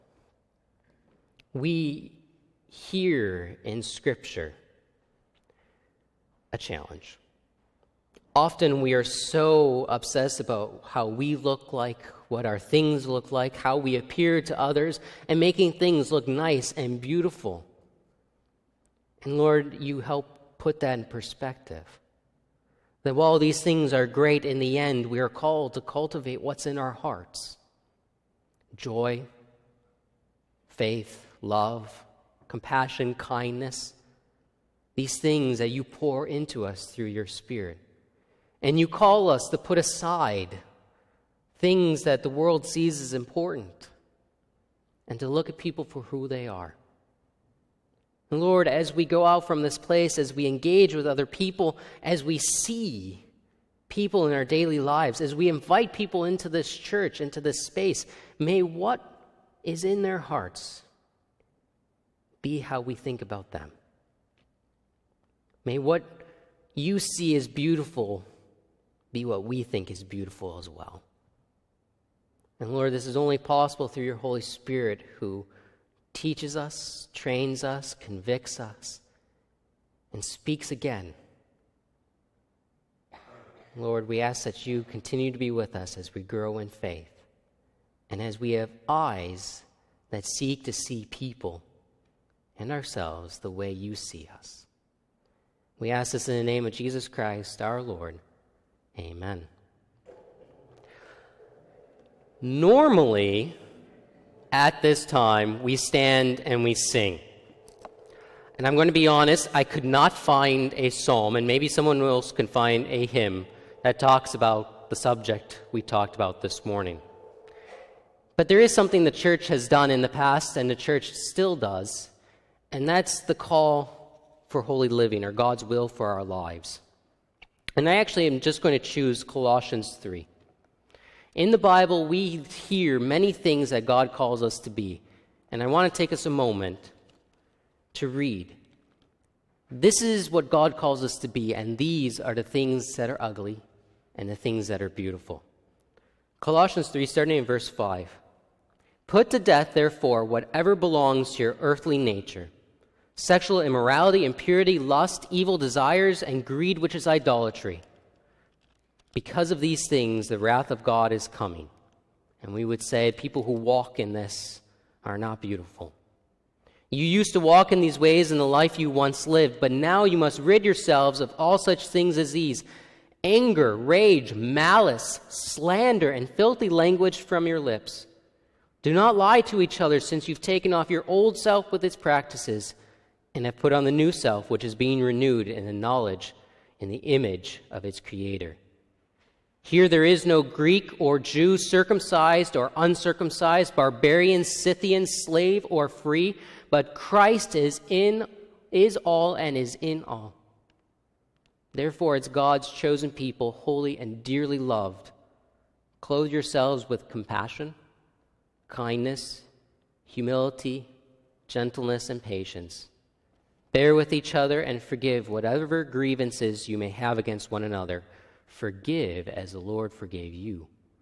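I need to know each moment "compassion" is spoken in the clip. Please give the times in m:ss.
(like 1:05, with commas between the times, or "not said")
0:32, 3:27.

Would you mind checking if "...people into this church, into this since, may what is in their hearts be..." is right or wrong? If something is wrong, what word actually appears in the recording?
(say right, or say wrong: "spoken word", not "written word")
wrong: "space", not "since".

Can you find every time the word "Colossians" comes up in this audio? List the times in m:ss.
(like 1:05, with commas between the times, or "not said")
2:09, 2:26.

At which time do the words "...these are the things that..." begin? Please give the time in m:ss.
2:21.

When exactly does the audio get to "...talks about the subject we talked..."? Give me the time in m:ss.
1:53.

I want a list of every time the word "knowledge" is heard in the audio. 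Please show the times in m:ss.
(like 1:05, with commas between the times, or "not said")
3:05.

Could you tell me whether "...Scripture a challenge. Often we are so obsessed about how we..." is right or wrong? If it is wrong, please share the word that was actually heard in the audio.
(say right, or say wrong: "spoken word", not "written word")
right.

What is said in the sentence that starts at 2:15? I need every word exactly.
And I want to take us a moment to read.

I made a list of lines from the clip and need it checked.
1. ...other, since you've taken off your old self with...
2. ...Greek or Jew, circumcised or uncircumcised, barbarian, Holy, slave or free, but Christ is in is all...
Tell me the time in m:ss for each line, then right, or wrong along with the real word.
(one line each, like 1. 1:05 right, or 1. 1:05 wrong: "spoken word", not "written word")
1. 2:59 right
2. 3:10 wrong: "Scythian", not "Holy".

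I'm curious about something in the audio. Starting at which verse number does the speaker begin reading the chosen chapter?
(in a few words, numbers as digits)
5.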